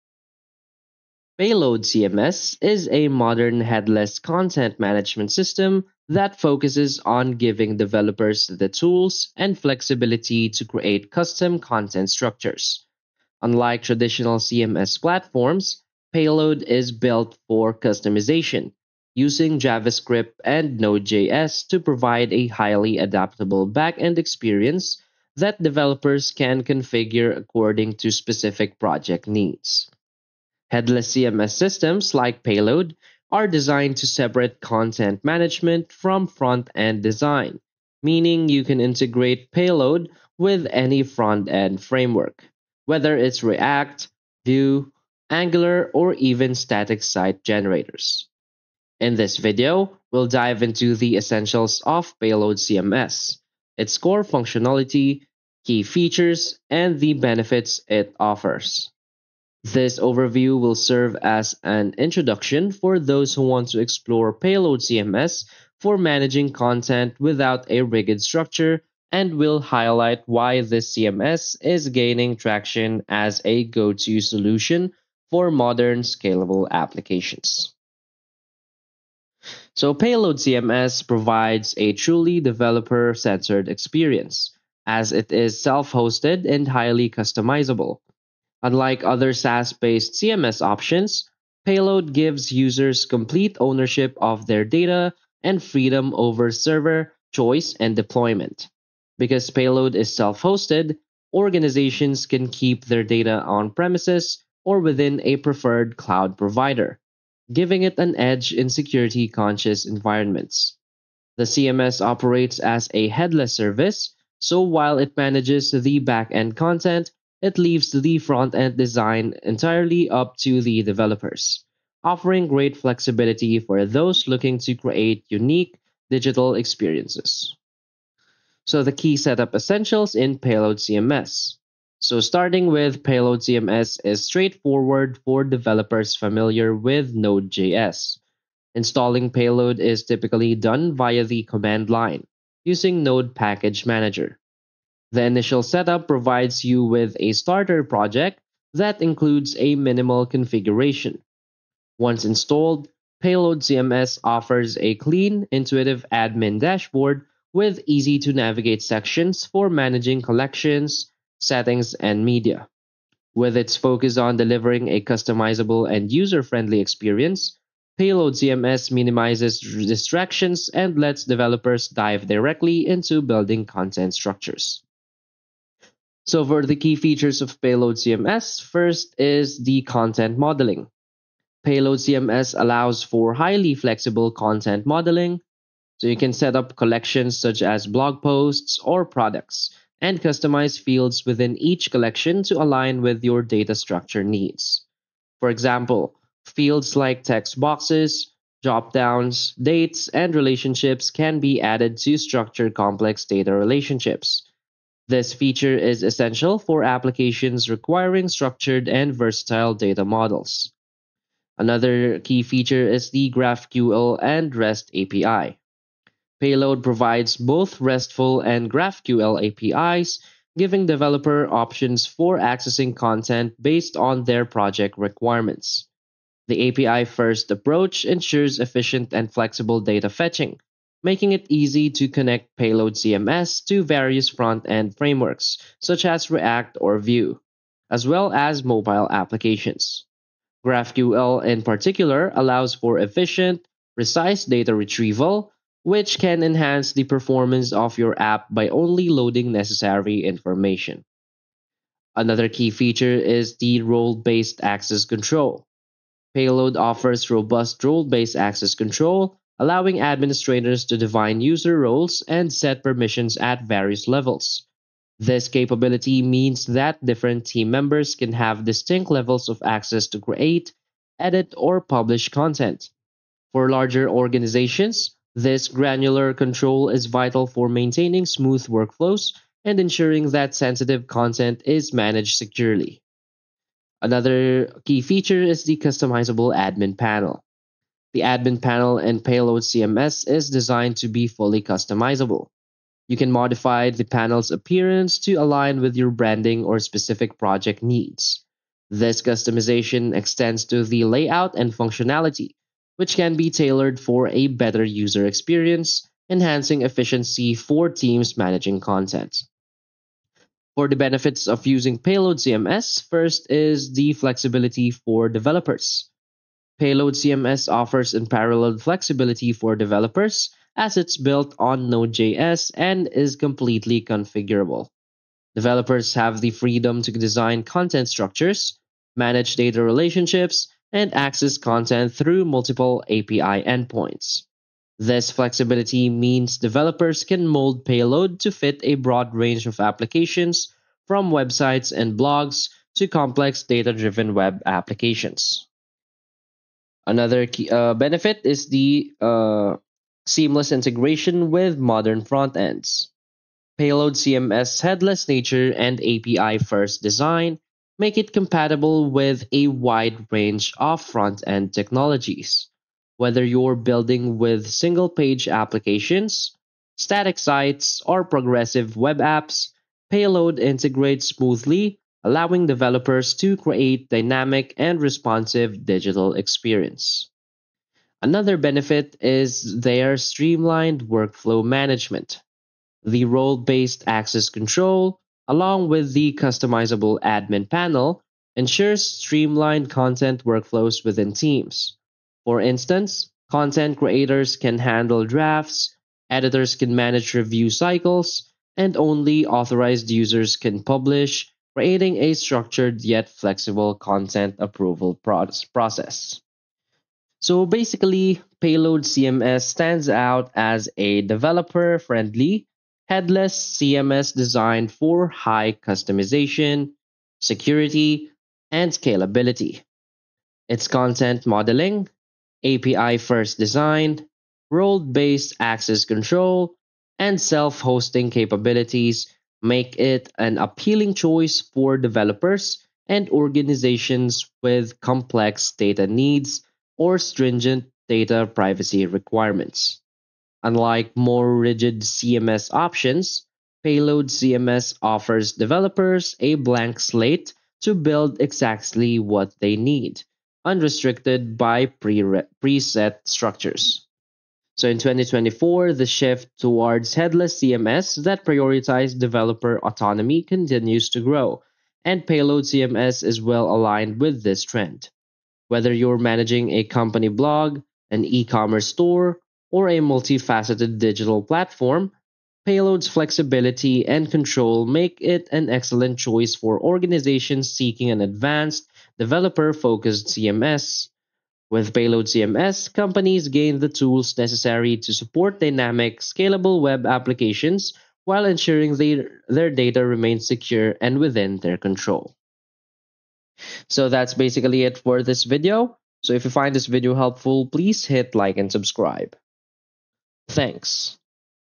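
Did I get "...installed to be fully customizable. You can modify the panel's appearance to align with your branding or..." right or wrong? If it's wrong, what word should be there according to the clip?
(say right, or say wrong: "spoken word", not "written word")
wrong: "designed", not "installed".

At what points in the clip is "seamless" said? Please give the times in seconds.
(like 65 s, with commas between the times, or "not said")
350 s.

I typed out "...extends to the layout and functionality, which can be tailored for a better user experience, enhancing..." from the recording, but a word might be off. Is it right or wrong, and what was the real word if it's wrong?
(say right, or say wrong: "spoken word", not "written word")
right.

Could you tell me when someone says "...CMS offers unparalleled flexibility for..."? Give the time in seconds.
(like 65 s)
317 s.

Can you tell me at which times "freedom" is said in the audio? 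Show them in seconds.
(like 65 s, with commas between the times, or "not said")
95 s, 326 s.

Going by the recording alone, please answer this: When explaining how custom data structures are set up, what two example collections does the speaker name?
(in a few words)
blog posts or products.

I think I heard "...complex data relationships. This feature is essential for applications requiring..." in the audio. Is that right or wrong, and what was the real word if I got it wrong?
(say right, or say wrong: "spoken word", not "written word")
right.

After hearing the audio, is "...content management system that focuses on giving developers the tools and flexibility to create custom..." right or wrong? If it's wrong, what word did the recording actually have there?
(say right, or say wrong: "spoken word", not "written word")
right.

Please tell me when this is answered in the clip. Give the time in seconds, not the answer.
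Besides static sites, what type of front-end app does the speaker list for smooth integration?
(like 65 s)
368 s.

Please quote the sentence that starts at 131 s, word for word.
So, starting with Payload CMS is straightforward for developers familiar with Node.js.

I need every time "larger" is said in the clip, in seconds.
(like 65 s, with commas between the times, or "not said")
273 s.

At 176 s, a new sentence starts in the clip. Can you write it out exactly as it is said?
So for the key features of Payload CMS, first is the content modeling.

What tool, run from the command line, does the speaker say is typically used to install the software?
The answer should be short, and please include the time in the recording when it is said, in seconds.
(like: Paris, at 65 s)
Node Package Manager, at 143 s.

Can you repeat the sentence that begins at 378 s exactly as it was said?
Another benefit is their streamlined workflow management.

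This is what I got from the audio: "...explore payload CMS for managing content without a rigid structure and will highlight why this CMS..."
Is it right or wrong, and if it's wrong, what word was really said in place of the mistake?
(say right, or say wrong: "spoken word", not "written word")
right.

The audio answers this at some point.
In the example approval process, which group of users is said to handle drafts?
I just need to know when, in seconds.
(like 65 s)
393 s.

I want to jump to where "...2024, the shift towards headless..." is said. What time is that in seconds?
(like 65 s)
454 s.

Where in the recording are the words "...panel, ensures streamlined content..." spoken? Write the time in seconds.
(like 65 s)
387 s.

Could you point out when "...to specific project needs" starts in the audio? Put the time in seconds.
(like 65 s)
28 s.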